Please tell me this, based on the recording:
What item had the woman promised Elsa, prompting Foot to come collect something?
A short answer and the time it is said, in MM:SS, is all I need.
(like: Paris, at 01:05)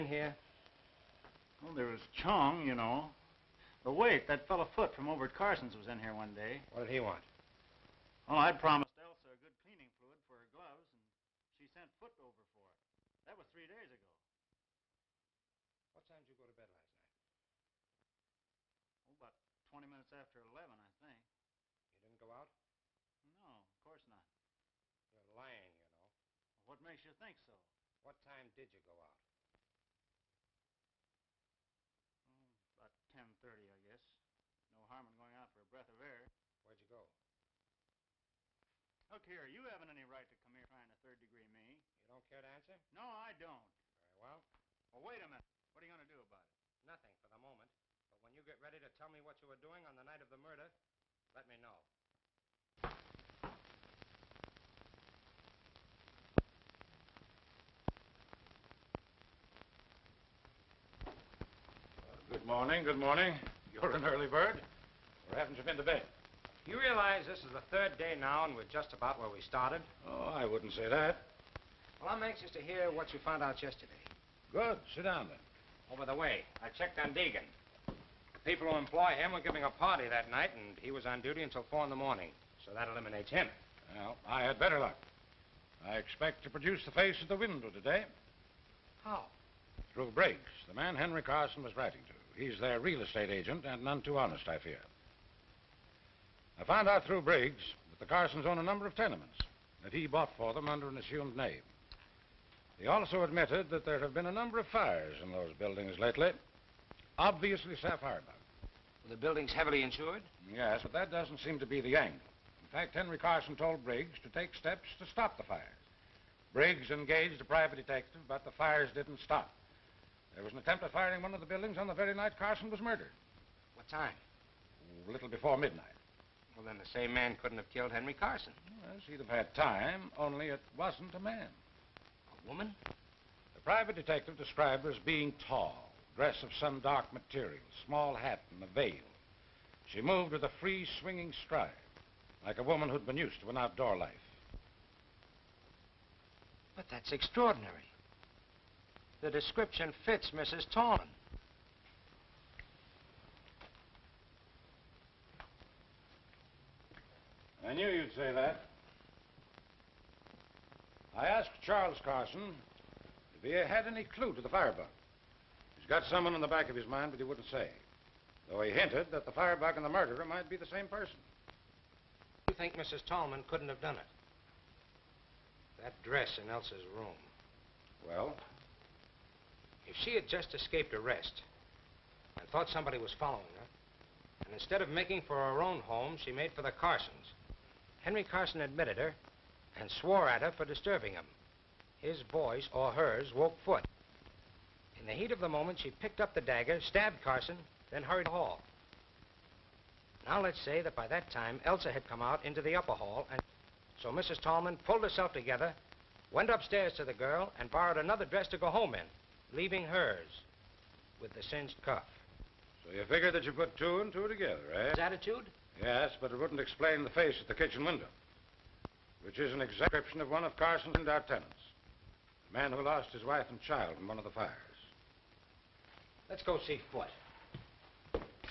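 cleaning fluid, at 00:09.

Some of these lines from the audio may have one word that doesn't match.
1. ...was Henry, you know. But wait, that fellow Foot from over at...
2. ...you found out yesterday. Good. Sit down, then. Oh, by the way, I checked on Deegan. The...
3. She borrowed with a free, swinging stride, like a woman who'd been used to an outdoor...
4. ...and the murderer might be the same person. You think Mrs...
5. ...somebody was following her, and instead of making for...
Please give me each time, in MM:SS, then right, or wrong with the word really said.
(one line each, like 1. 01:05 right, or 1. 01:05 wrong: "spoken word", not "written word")
1. 00:01 wrong: "Choong", not "Henry"
2. 01:13 right
3. 02:19 wrong: "moved", not "borrowed"
4. 02:49 right
5. 03:02 right.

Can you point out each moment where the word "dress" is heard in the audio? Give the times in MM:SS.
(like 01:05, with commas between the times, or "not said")
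02:16, 02:56, 03:28.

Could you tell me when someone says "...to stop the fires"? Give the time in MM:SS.
01:54.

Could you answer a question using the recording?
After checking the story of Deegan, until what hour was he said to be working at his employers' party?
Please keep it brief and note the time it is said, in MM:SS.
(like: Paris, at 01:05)
4 in the morning, at 01:21.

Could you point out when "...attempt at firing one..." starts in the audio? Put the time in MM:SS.
02:00.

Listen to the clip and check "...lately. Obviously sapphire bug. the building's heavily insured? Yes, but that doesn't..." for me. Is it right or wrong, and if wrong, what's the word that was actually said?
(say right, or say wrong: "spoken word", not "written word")
right.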